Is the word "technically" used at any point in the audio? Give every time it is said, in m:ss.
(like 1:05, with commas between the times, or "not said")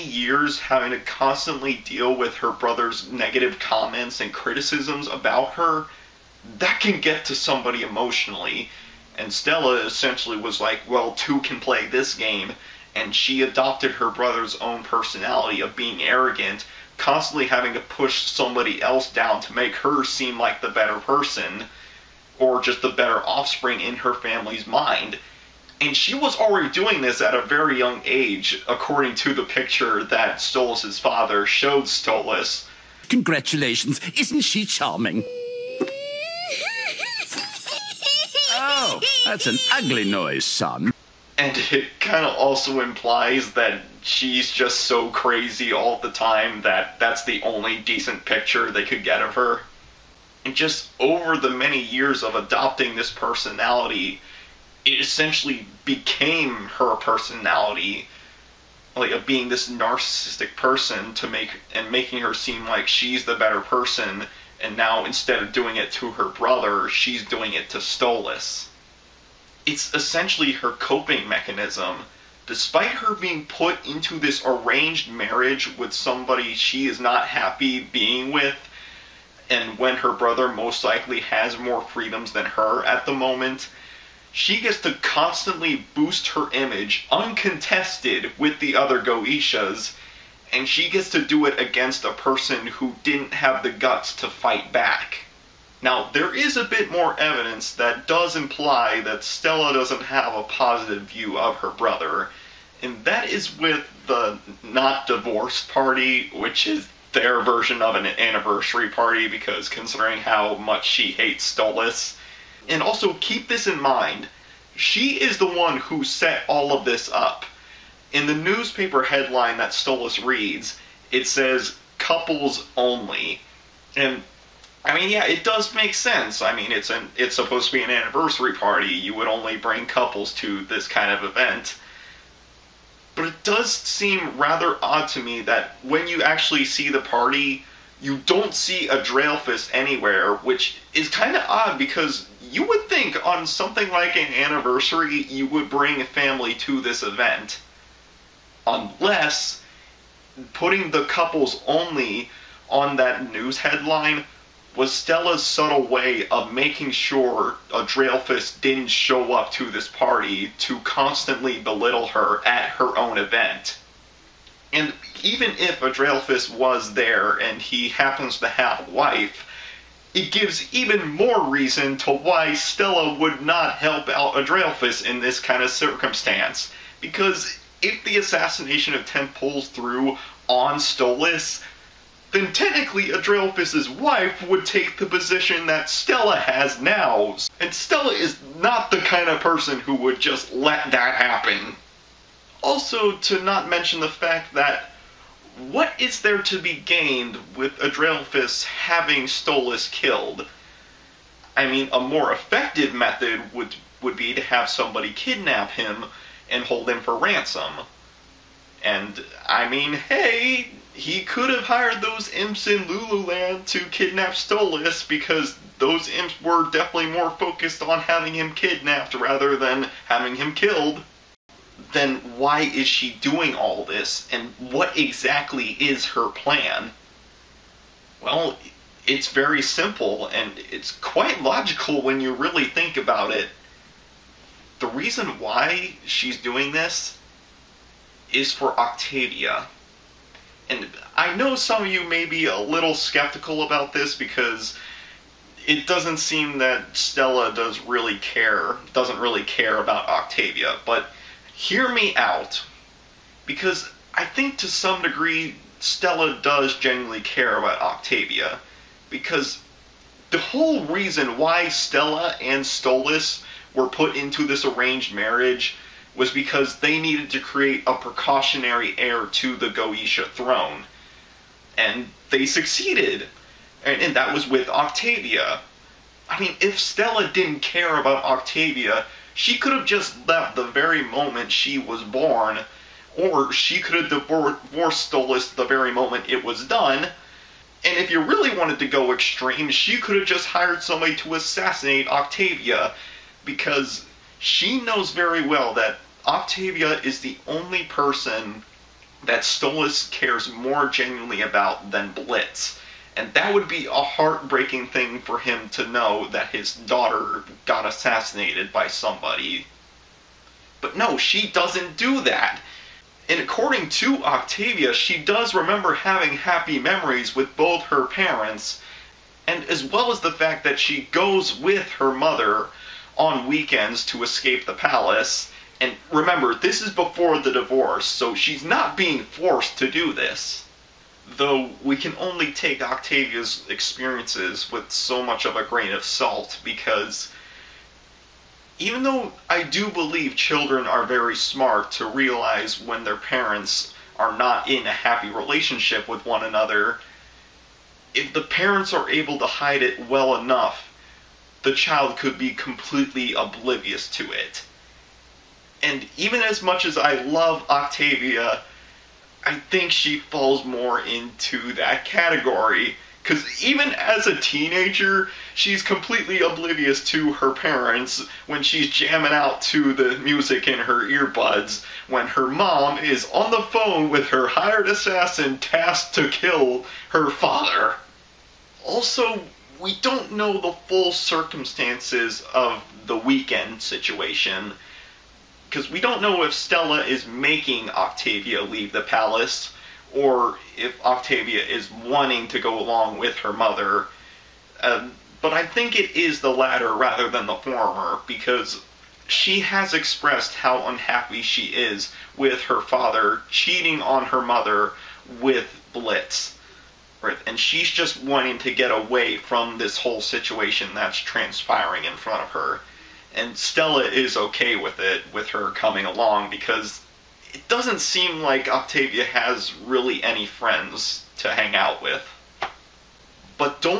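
3:02.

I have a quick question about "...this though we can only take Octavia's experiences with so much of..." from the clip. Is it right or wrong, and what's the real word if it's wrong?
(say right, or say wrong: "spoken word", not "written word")
right.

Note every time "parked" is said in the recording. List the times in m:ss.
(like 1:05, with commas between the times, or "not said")
not said.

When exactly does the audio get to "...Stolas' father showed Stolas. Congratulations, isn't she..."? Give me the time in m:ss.
0:30.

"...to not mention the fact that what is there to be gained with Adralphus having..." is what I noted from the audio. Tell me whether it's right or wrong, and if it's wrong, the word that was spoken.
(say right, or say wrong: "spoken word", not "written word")
right.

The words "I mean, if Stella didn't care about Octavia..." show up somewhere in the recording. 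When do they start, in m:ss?
4:36.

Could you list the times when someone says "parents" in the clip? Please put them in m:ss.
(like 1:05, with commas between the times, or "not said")
5:18, 5:43, 5:48, 6:07.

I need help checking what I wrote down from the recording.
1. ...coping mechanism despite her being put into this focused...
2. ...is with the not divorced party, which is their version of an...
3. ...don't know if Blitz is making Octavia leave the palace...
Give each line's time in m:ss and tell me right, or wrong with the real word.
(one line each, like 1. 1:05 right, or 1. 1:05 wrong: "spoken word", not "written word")
1. 1:10 wrong: "arranged", not "focused"
2. 1:43 right
3. 6:25 wrong: "Stella", not "Blitz".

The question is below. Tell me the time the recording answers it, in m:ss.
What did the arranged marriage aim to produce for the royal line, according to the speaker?
4:27.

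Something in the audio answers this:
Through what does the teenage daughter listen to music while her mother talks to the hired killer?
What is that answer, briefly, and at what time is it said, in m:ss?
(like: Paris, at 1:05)
Earbuds, at 6:11.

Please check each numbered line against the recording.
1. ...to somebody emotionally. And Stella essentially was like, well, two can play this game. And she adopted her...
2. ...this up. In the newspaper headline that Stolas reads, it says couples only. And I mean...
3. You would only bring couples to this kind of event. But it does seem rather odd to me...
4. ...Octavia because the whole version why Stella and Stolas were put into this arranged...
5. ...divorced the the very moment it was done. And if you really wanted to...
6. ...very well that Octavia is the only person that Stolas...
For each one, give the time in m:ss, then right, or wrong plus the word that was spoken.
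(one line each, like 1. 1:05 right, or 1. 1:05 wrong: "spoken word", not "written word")
1. 0:07 right
2. 1:56 right
3. 2:08 right
4. 4:17 wrong: "reason", not "version"
5. 4:44 right
6. 4:55 right.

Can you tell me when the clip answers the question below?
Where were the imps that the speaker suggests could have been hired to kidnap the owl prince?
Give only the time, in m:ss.
3:32.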